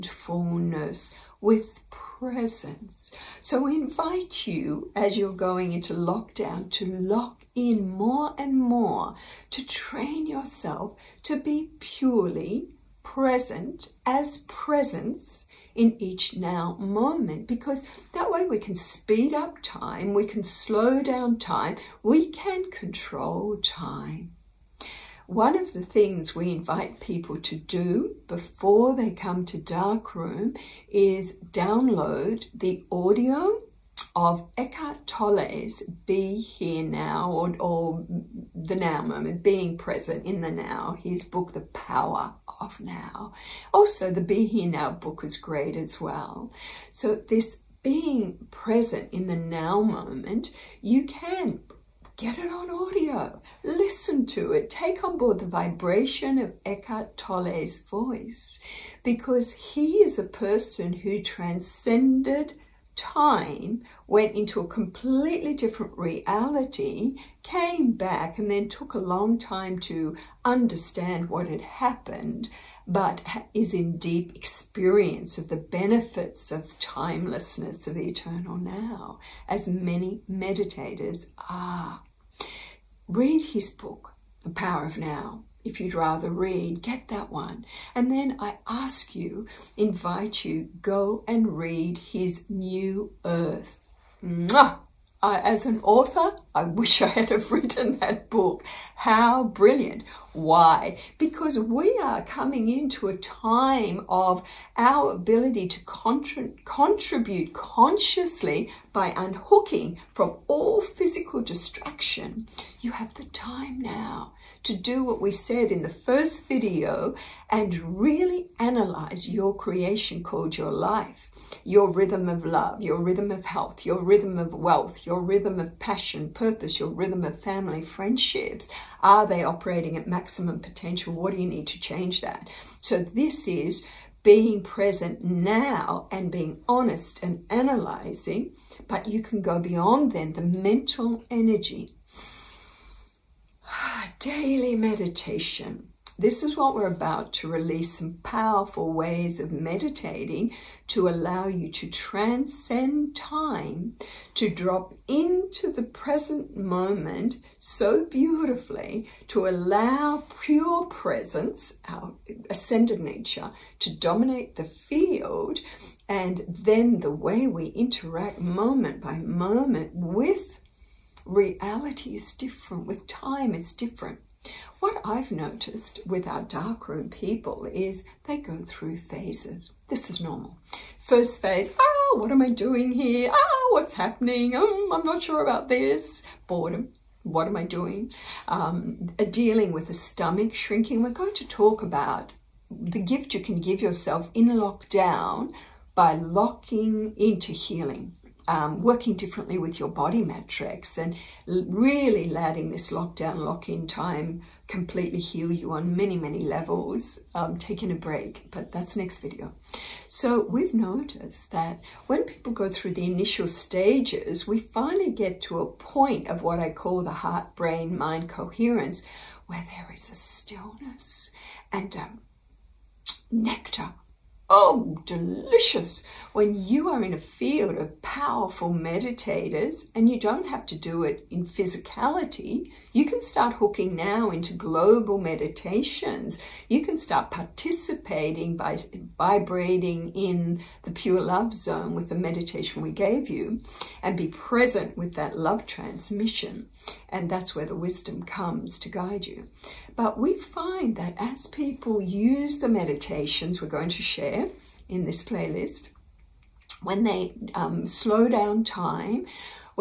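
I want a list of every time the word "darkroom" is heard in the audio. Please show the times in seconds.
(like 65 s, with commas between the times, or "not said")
29 s, 176 s.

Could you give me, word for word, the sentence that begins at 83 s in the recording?
Read his book, The Power of Now if you'd rather read, get that one.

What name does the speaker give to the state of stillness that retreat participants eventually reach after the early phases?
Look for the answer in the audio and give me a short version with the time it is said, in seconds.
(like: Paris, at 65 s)
heart, brain, mind coherence, at 217 s.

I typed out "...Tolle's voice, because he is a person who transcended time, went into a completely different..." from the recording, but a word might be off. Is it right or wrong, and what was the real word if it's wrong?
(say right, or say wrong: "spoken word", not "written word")
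right.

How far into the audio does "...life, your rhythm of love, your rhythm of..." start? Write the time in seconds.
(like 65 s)
120 s.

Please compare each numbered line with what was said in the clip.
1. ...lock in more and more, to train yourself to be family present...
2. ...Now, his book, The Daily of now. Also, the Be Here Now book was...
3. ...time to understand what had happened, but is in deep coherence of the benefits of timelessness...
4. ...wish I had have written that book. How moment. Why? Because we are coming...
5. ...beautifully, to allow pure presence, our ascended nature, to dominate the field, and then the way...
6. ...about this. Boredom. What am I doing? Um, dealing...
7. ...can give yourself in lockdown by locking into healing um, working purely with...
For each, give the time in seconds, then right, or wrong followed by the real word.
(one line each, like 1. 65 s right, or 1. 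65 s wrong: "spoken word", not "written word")
1. 6 s wrong: "purely", not "family"
2. 40 s wrong: "Power", not "Daily"
3. 69 s wrong: "experience", not "coherence"
4. 96 s wrong: "brilliant", not "moment"
5. 158 s right
6. 185 s right
7. 193 s wrong: "differently", not "purely".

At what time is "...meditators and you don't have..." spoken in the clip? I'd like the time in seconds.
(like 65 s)
228 s.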